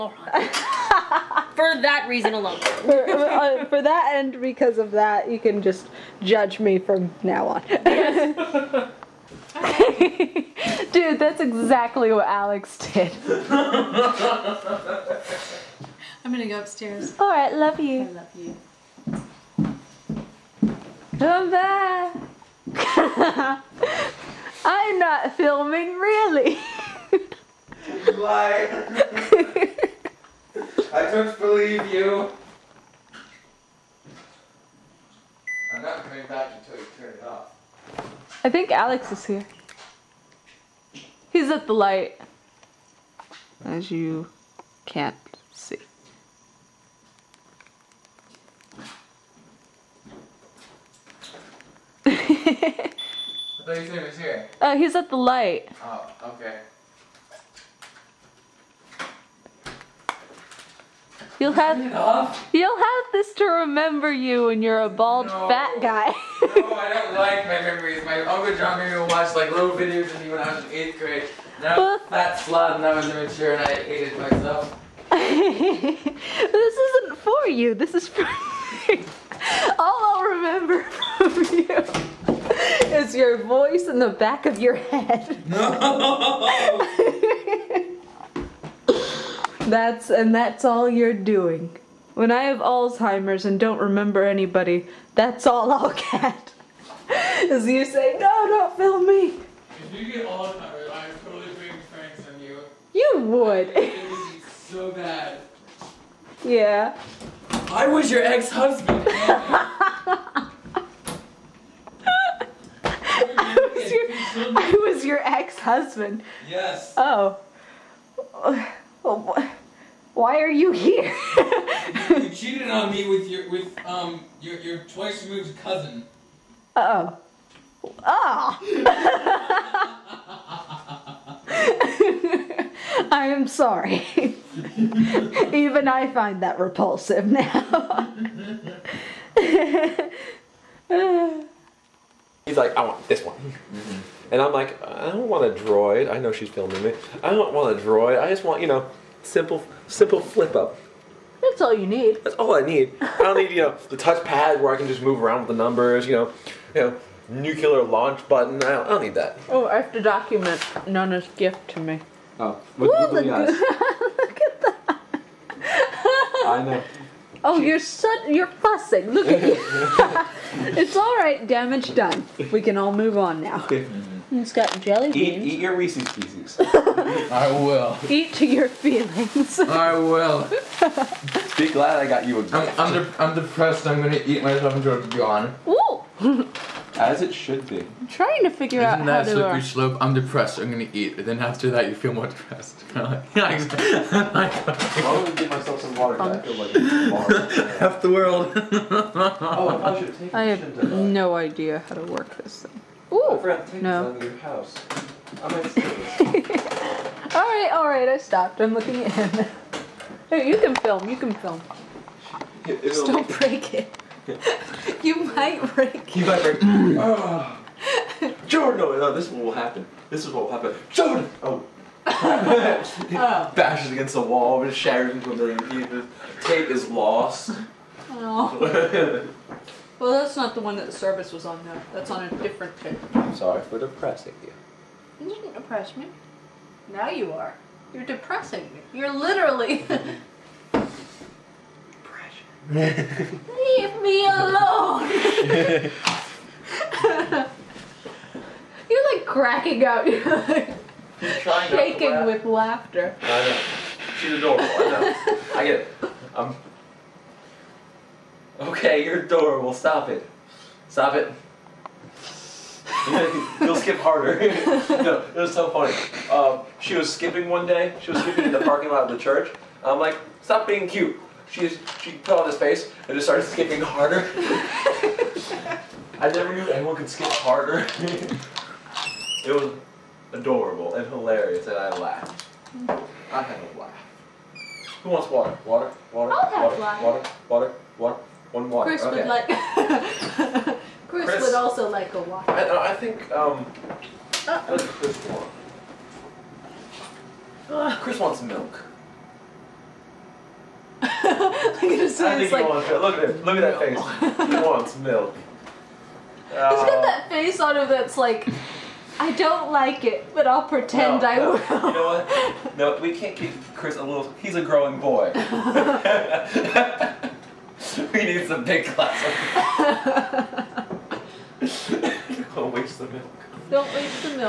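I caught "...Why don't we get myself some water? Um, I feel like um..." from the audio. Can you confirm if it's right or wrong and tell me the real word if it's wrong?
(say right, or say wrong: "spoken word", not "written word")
right.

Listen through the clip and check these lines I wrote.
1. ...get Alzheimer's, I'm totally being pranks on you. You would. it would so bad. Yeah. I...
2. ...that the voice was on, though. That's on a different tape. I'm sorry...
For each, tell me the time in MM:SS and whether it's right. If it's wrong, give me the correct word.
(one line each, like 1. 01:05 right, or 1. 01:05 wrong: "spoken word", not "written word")
1. 01:40 right
2. 03:50 wrong: "service", not "voice".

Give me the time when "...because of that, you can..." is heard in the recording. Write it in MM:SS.
00:04.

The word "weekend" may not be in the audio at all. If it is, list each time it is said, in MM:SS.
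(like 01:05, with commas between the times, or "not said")
not said.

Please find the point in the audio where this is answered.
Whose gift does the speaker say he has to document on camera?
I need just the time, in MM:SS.
02:40.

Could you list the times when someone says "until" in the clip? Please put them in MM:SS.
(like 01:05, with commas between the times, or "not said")
00:36, 03:04.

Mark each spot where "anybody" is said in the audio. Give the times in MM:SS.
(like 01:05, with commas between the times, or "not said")
01:34.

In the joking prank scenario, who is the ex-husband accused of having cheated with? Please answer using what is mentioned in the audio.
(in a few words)
twice removed cousin.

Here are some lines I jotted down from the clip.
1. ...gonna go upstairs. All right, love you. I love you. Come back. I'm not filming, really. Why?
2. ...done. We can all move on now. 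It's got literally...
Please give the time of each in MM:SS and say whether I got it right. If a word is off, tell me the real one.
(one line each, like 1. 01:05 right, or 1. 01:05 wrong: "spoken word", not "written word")
1. 00:16 right
2. 02:51 wrong: "jelly", not "literally".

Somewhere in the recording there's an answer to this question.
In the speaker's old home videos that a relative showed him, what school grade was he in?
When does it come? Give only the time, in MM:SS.
01:10.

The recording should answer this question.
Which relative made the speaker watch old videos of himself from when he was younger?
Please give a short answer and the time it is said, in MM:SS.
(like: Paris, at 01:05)
Uncle John, at 01:08.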